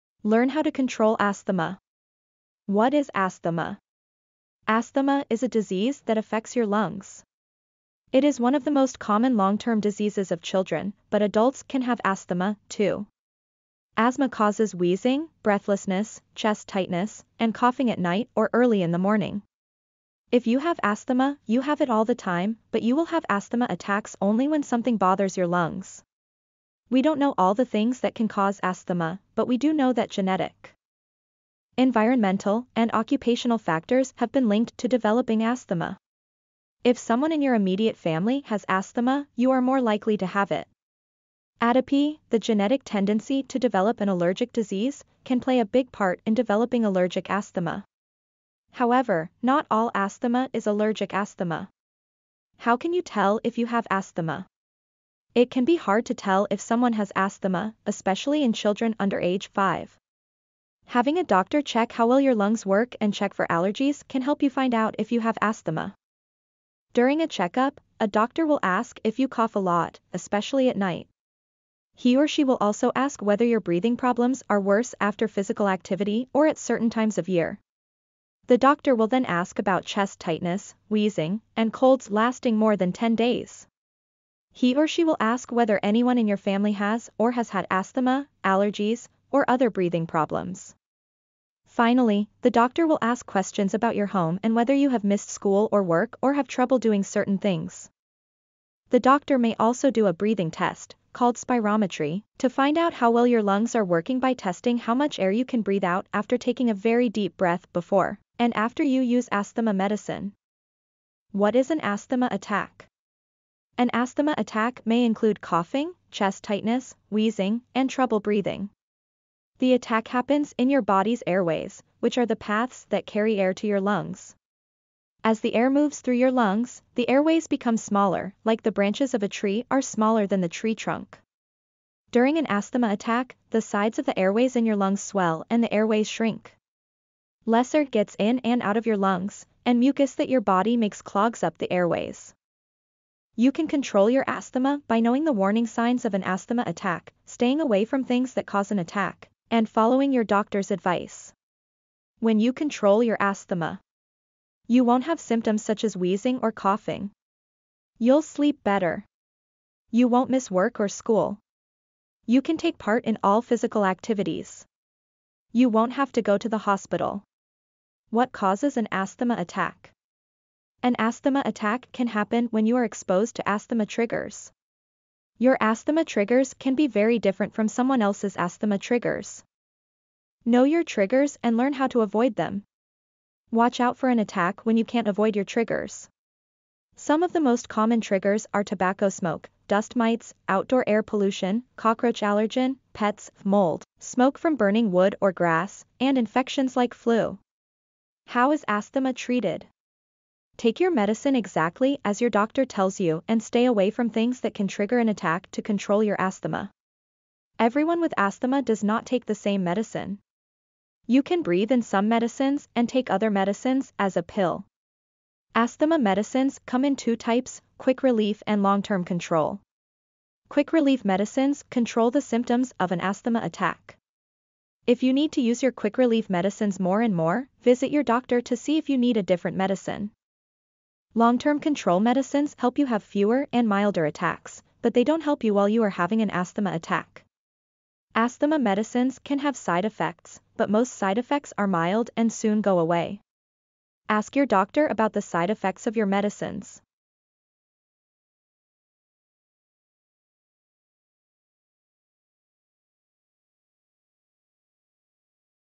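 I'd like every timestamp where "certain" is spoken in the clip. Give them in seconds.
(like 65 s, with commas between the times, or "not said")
76 s, 97 s.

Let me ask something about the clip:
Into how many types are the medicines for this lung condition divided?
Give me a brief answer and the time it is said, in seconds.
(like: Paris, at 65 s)
2, at 216 s.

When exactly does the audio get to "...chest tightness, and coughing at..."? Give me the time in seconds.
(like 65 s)
16 s.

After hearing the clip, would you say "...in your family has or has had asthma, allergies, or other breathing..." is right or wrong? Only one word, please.
right.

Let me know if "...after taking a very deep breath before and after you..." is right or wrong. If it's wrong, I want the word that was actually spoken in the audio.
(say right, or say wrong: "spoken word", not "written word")
right.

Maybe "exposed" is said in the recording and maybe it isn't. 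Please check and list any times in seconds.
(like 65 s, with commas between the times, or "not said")
172 s.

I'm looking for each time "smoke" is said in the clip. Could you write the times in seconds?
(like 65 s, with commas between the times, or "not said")
189 s, 193 s.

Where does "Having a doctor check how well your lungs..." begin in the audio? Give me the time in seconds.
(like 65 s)
60 s.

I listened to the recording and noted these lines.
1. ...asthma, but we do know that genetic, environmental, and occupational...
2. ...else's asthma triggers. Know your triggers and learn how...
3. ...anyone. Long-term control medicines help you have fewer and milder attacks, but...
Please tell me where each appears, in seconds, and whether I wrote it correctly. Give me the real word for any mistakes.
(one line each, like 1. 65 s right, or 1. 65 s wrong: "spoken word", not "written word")
1. 28 s right
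2. 178 s right
3. 229 s wrong: "medicine", not "anyone".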